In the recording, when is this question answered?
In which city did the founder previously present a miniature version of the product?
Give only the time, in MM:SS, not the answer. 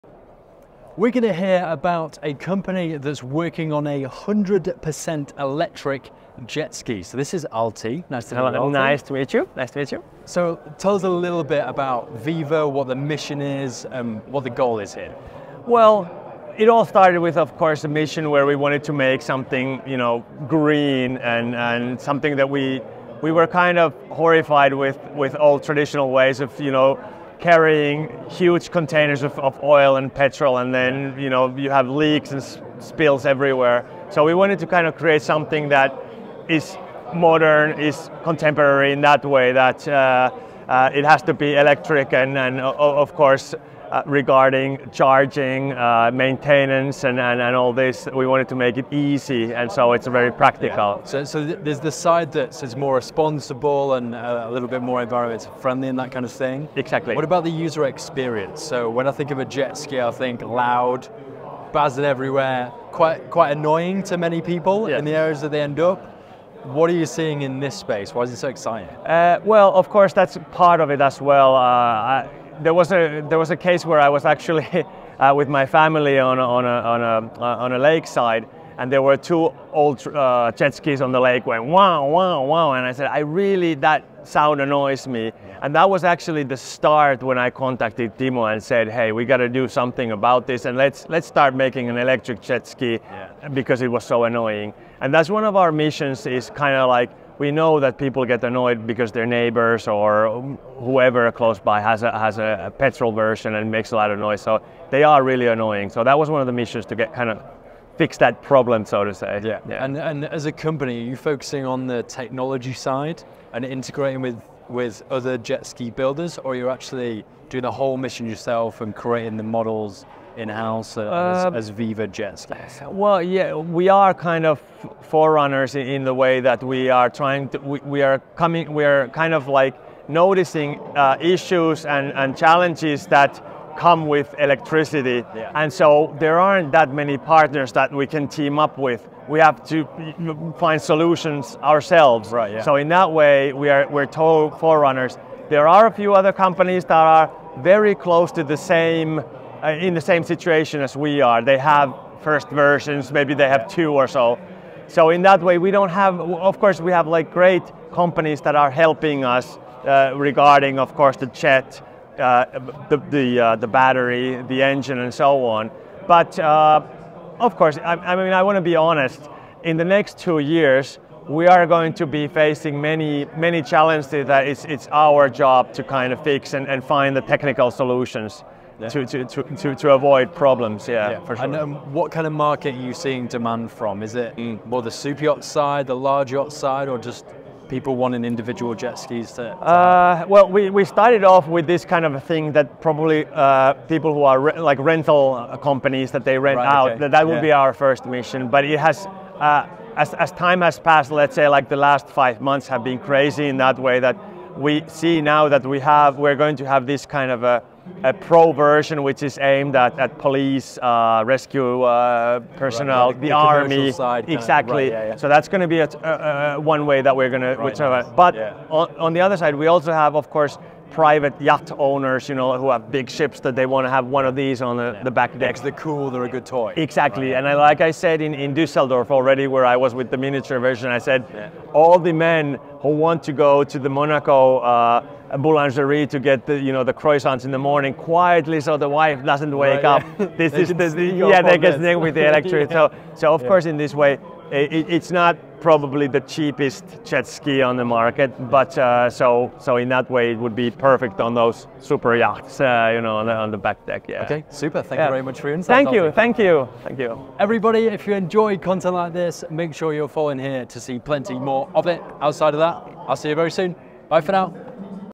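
03:48.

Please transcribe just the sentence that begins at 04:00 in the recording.
This is the, yeah, they get with the electric.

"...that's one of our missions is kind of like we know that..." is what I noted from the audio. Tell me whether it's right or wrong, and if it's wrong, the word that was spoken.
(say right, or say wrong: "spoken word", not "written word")
right.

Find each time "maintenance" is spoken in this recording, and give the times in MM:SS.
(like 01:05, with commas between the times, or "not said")
00:46.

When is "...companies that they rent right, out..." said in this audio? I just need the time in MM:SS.
03:15.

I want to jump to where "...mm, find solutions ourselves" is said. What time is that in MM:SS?
02:19.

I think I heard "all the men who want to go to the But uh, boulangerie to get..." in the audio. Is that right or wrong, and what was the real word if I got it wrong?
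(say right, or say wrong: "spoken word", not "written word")
wrong: "Monaco", not "But".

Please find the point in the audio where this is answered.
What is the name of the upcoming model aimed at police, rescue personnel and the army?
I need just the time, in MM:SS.
03:28.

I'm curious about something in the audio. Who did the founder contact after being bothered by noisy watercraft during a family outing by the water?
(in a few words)
Timo.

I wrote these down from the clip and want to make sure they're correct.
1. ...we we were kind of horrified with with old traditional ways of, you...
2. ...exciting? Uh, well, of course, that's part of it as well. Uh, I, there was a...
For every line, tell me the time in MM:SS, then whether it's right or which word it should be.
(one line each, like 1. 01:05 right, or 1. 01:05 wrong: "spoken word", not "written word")
1. 00:22 right
2. 01:08 right.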